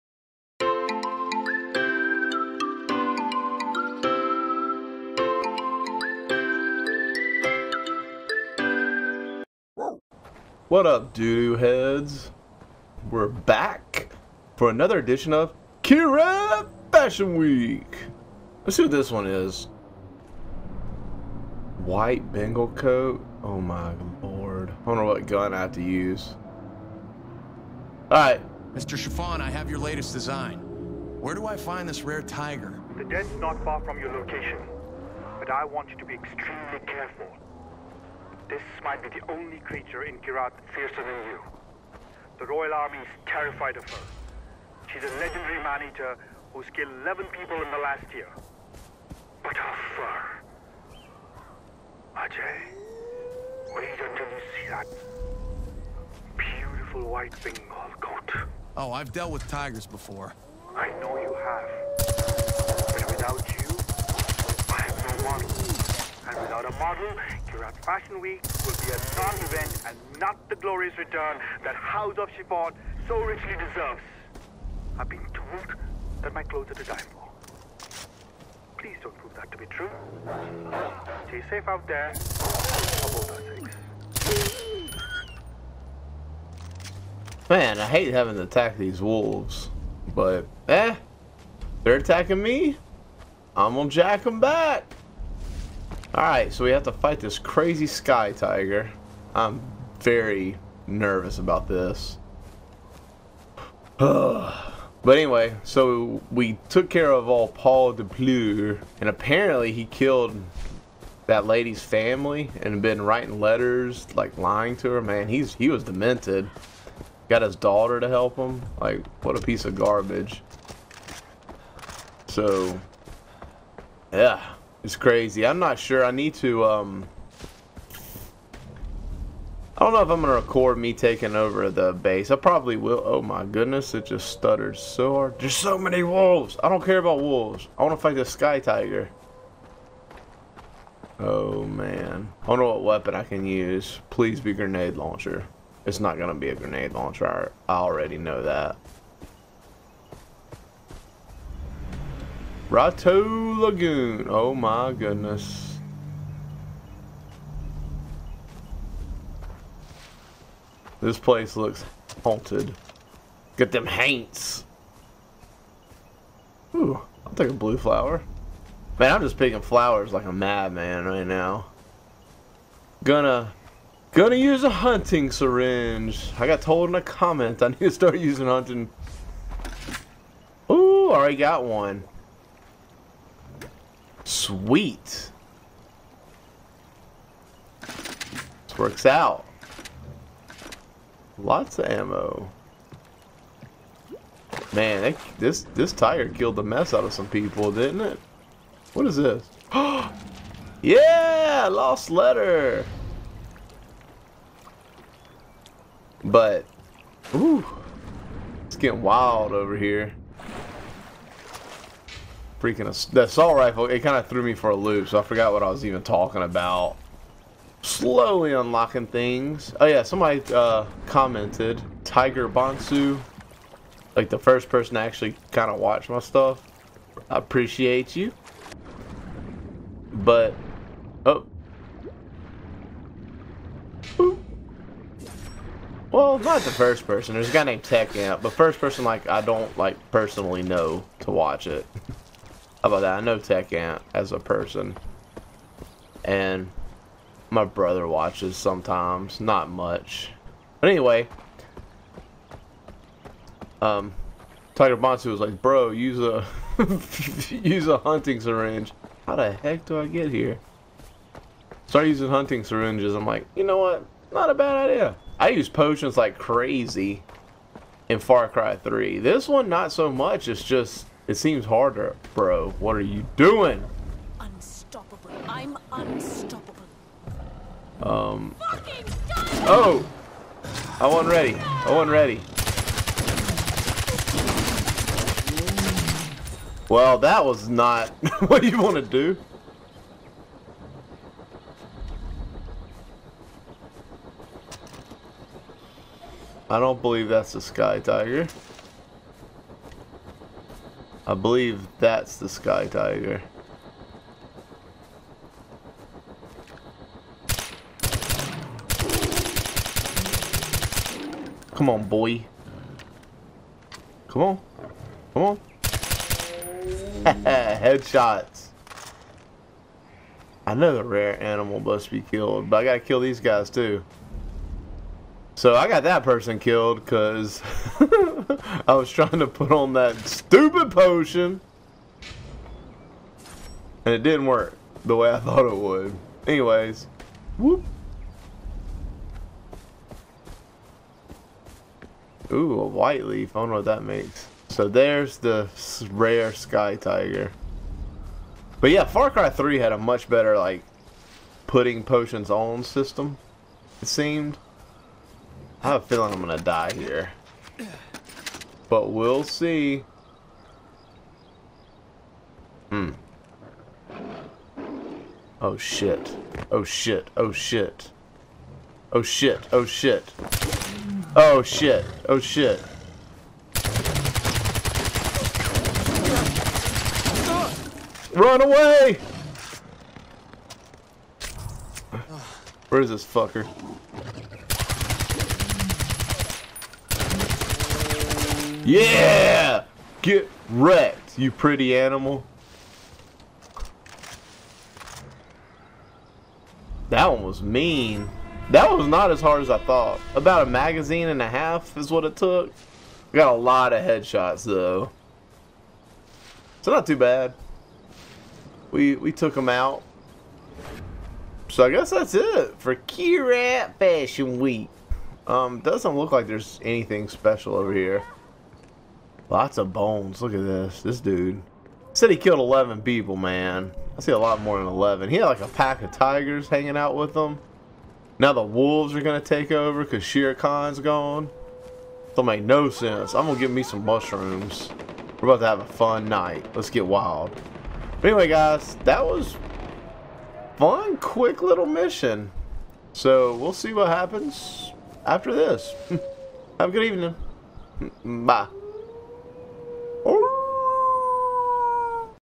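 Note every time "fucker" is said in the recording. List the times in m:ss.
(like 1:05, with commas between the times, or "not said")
6:23.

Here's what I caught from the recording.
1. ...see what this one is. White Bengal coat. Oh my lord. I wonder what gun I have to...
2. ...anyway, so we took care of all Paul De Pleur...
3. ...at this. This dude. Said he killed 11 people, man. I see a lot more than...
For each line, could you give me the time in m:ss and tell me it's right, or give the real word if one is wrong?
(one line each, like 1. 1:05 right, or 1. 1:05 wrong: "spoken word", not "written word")
1. 0:18 right
2. 1:45 right
3. 7:00 right.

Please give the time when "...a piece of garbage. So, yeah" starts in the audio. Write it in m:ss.
1:59.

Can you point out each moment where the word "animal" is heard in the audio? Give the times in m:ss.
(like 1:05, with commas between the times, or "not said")
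5:21, 6:31.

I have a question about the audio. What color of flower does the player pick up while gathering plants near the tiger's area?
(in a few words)
Blue.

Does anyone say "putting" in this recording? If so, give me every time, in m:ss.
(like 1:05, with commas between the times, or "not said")
5:51.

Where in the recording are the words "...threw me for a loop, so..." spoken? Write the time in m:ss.
3:34.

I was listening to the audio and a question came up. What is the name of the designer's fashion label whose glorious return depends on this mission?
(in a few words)
House of Shuffoe.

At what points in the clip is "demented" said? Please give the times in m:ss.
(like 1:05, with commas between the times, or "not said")
1:55.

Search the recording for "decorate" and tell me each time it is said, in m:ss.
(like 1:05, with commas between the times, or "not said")
not said.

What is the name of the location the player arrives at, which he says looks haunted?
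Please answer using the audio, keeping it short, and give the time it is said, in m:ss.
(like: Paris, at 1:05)
Rato Lagoon, at 2:32.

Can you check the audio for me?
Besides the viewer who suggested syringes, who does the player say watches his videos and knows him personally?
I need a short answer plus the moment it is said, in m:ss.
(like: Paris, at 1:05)
Tech Amp, at 3:57.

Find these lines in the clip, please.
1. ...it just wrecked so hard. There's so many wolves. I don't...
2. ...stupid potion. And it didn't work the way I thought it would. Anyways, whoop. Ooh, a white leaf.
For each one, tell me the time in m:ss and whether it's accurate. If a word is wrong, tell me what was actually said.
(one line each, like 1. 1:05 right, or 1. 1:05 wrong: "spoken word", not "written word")
1. 2:13 wrong: "stuttered", not "wrecked"
2. 5:30 right.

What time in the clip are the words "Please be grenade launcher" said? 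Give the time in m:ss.
2:24.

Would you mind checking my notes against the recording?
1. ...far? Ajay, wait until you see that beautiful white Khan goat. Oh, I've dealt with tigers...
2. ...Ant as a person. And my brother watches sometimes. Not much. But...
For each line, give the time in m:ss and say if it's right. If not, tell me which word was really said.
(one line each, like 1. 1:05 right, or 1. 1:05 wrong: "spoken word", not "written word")
1. 0:49 wrong: "Bengal", not "Khan"
2. 4:03 right.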